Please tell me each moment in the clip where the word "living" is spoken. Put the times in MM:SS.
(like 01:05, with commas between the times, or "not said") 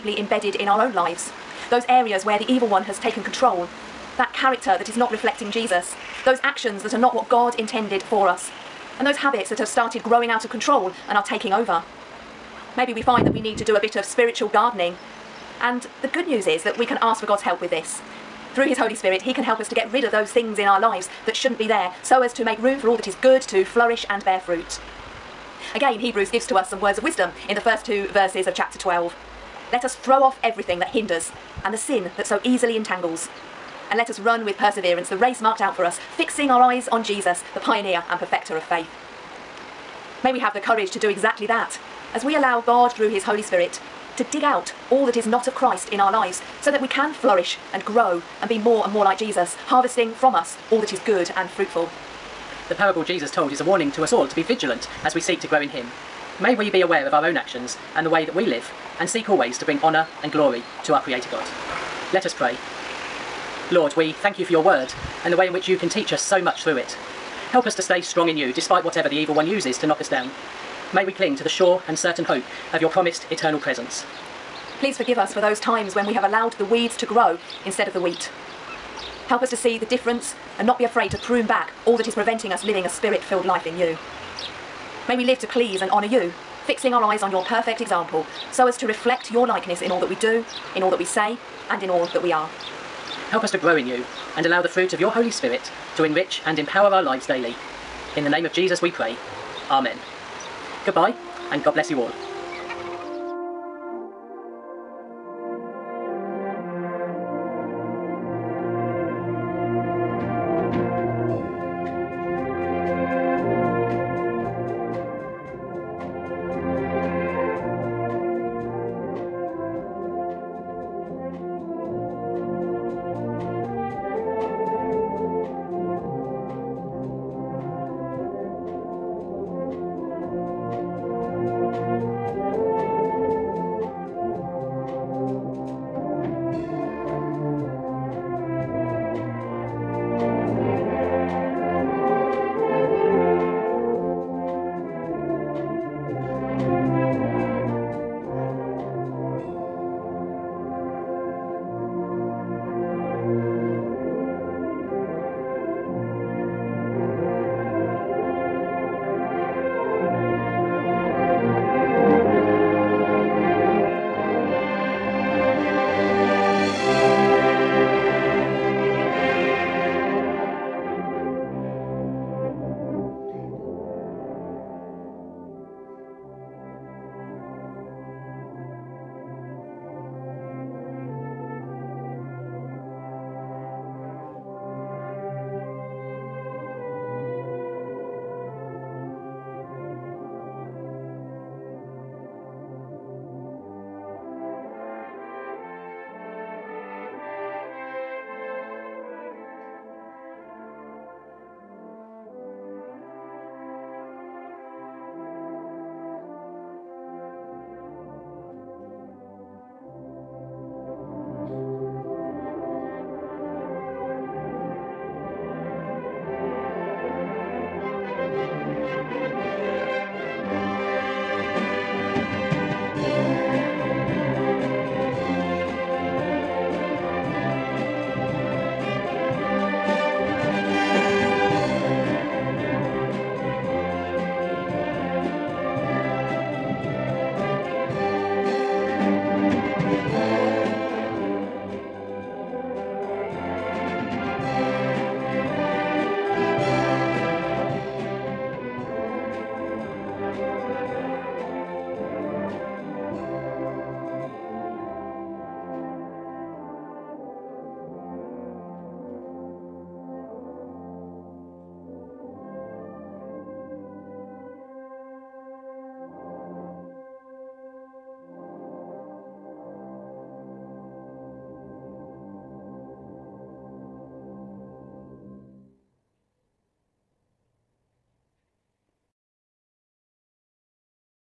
01:22.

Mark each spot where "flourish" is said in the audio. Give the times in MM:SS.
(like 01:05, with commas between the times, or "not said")
00:23, 00:47.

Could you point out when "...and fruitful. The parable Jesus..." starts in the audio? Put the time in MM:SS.
00:51.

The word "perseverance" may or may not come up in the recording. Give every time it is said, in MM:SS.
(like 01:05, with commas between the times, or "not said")
00:34.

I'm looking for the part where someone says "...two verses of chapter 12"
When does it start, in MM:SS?
00:27.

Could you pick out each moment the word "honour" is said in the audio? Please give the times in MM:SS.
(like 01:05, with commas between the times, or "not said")
00:59, 01:25.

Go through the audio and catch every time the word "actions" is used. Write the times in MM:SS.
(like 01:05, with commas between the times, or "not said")
00:06, 00:57.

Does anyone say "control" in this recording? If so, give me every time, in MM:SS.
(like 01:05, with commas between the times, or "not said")
00:03, 00:10.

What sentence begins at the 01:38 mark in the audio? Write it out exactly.
In the name of Jesus we pray.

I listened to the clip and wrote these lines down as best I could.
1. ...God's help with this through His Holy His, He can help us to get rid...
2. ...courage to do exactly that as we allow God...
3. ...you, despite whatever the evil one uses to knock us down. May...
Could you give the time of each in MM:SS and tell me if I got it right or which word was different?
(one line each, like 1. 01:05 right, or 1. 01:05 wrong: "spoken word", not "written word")
1. 00:17 wrong: "Spirit", not "His"
2. 00:40 right
3. 01:08 right.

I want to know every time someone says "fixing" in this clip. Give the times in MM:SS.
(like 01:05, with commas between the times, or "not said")
00:36, 01:26.